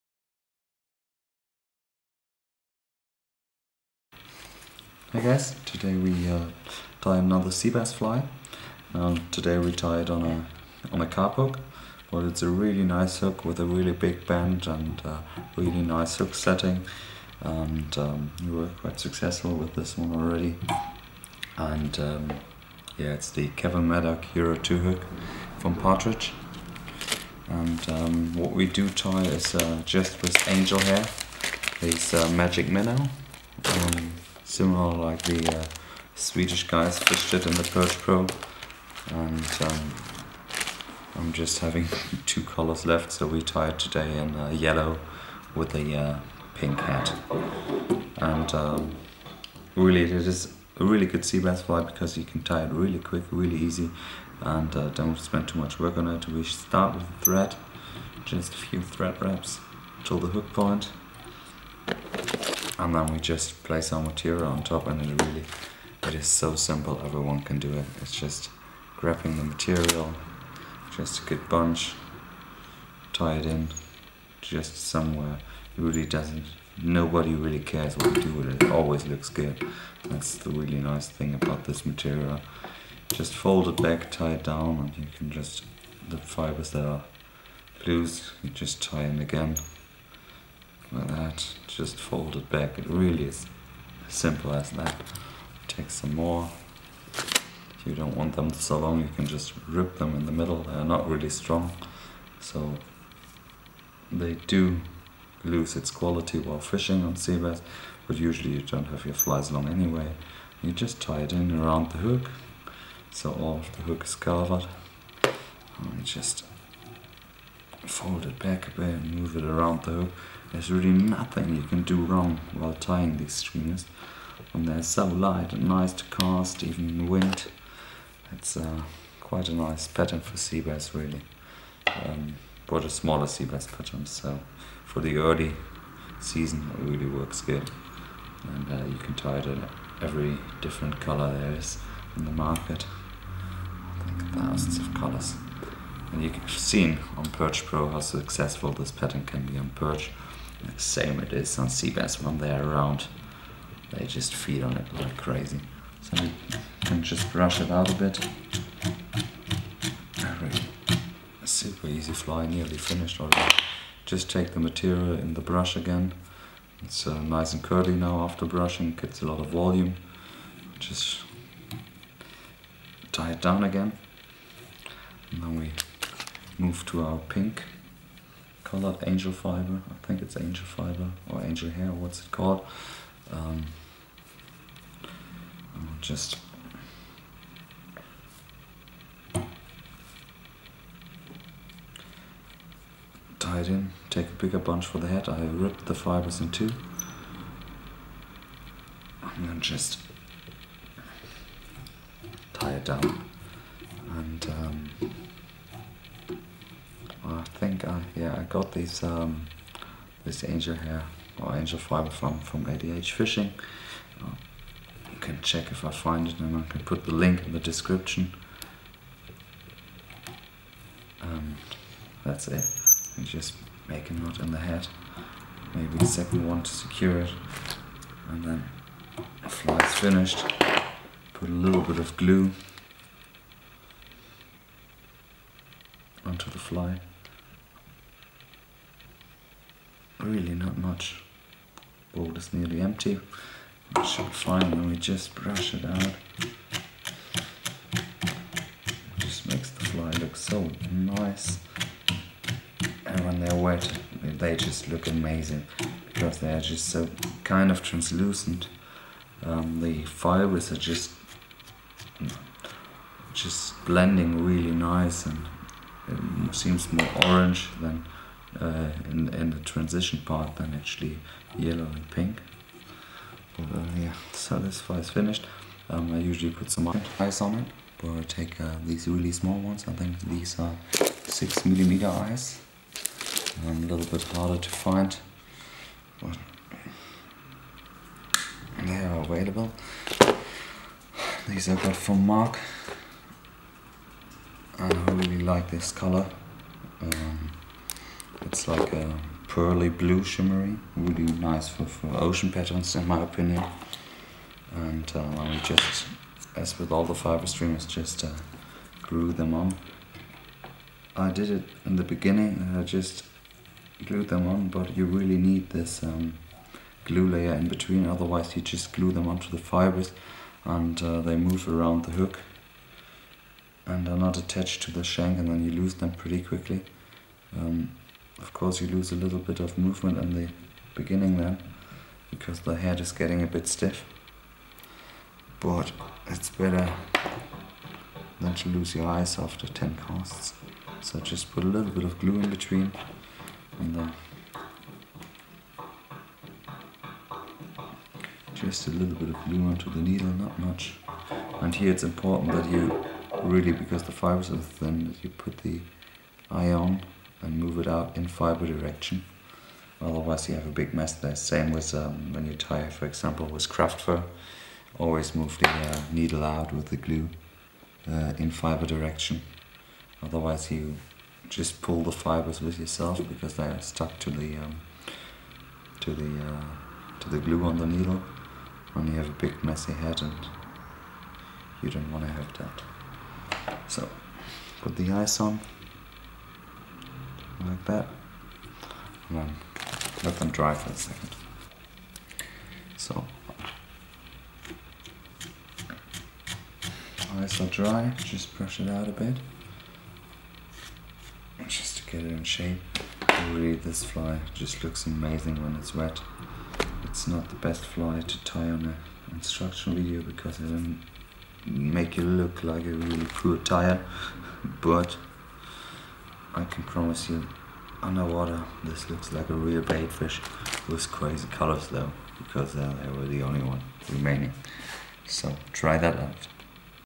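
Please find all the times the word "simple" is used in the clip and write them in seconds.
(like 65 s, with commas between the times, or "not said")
66 s, 94 s.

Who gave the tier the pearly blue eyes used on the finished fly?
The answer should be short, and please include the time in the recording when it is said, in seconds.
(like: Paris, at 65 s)
Mark, at 292 s.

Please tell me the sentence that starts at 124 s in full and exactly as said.
And they're so light and nice to cast, even in the wind.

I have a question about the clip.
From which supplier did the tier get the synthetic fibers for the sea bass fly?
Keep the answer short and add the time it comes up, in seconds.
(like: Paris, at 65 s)
ADH Fishing, at 212 s.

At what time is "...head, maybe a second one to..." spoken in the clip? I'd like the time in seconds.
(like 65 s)
224 s.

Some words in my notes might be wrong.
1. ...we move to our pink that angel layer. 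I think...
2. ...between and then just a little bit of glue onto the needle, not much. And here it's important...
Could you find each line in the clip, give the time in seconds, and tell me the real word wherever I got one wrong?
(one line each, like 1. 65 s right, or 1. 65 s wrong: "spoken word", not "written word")
1. 175 s wrong: "fiber", not "layer"
2. 342 s right.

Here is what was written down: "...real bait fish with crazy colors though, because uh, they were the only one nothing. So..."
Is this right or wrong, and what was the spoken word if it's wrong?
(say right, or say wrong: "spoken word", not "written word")
wrong: "remaining", not "nothing".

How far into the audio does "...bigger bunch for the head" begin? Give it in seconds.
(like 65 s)
194 s.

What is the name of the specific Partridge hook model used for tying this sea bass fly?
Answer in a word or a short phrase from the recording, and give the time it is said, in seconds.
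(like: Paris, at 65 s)
Kevin Maddock Hero 2, at 23 s.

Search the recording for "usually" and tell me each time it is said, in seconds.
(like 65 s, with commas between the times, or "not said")
108 s, 276 s.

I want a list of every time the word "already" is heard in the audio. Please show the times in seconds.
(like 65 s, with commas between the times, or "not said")
20 s, 163 s.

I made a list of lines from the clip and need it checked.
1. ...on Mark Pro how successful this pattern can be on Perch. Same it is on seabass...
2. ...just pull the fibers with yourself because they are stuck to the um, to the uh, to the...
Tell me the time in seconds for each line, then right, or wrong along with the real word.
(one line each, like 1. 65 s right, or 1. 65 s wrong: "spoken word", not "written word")
1. 147 s wrong: "Perch", not "Mark"
2. 371 s right.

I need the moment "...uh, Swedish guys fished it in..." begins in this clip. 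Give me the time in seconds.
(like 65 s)
35 s.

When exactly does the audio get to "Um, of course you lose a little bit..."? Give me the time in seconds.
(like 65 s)
327 s.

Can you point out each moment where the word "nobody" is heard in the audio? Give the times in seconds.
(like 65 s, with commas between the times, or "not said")
76 s.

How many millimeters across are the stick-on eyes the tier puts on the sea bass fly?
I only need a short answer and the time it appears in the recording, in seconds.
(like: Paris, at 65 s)
6 mm, at 281 s.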